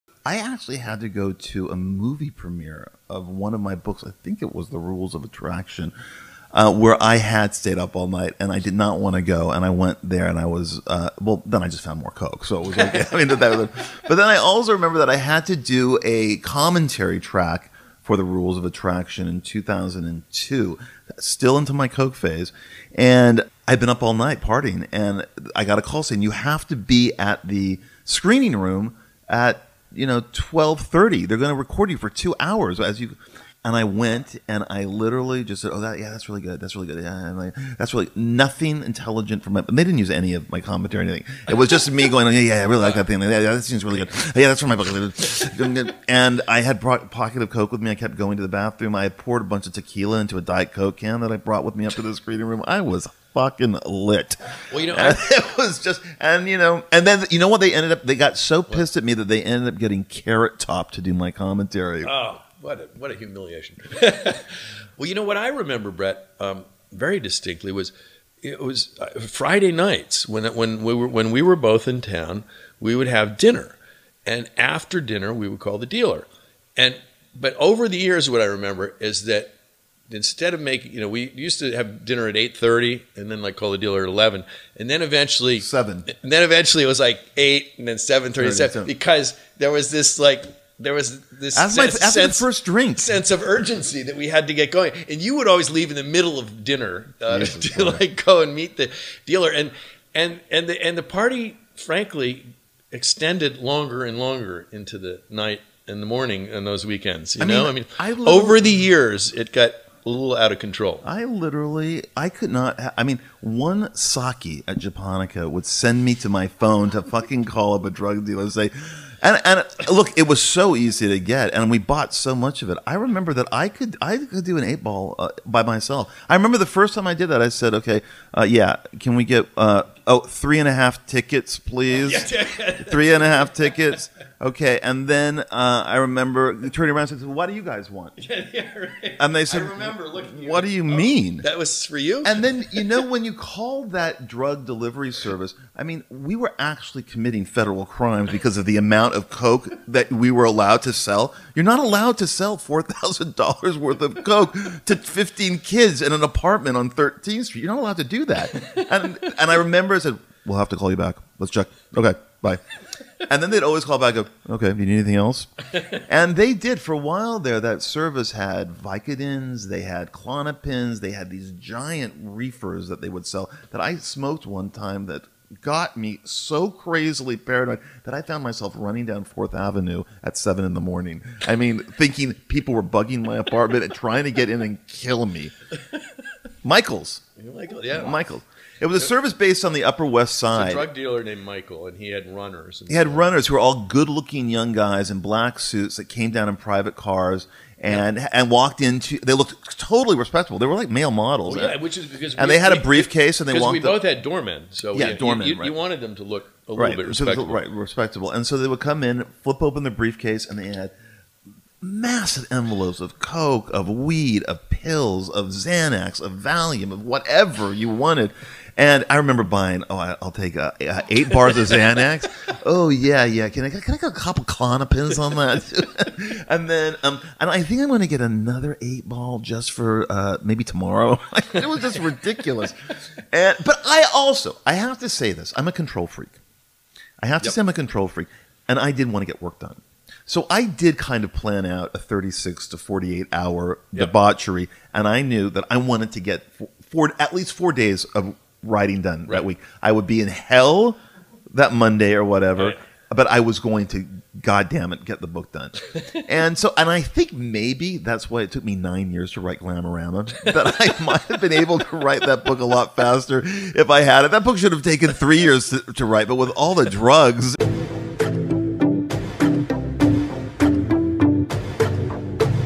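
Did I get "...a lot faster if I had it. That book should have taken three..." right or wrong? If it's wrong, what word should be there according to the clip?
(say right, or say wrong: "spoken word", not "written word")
right.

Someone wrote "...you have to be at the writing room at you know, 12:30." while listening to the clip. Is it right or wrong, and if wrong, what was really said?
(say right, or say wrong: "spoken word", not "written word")
wrong: "screening", not "writing".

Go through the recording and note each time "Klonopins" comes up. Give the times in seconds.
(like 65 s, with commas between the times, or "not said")
170 s, 224 s.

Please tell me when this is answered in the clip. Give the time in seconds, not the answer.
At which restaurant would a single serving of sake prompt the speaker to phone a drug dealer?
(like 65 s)
114 s.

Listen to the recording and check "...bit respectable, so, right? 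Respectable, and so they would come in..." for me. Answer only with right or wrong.
right.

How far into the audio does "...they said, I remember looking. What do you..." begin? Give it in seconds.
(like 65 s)
139 s.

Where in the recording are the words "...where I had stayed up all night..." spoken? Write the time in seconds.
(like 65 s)
6 s.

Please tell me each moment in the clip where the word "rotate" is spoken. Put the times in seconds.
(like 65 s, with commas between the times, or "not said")
not said.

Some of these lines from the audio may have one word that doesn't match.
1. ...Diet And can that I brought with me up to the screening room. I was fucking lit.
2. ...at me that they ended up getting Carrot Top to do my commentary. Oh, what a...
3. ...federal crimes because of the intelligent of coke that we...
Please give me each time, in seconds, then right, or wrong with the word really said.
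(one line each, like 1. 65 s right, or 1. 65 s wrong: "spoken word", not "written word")
1. 50 s wrong: "Coke", not "And"
2. 58 s right
3. 147 s wrong: "amount", not "intelligent".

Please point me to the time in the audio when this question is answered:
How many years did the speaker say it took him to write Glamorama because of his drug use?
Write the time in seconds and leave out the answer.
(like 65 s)
258 s.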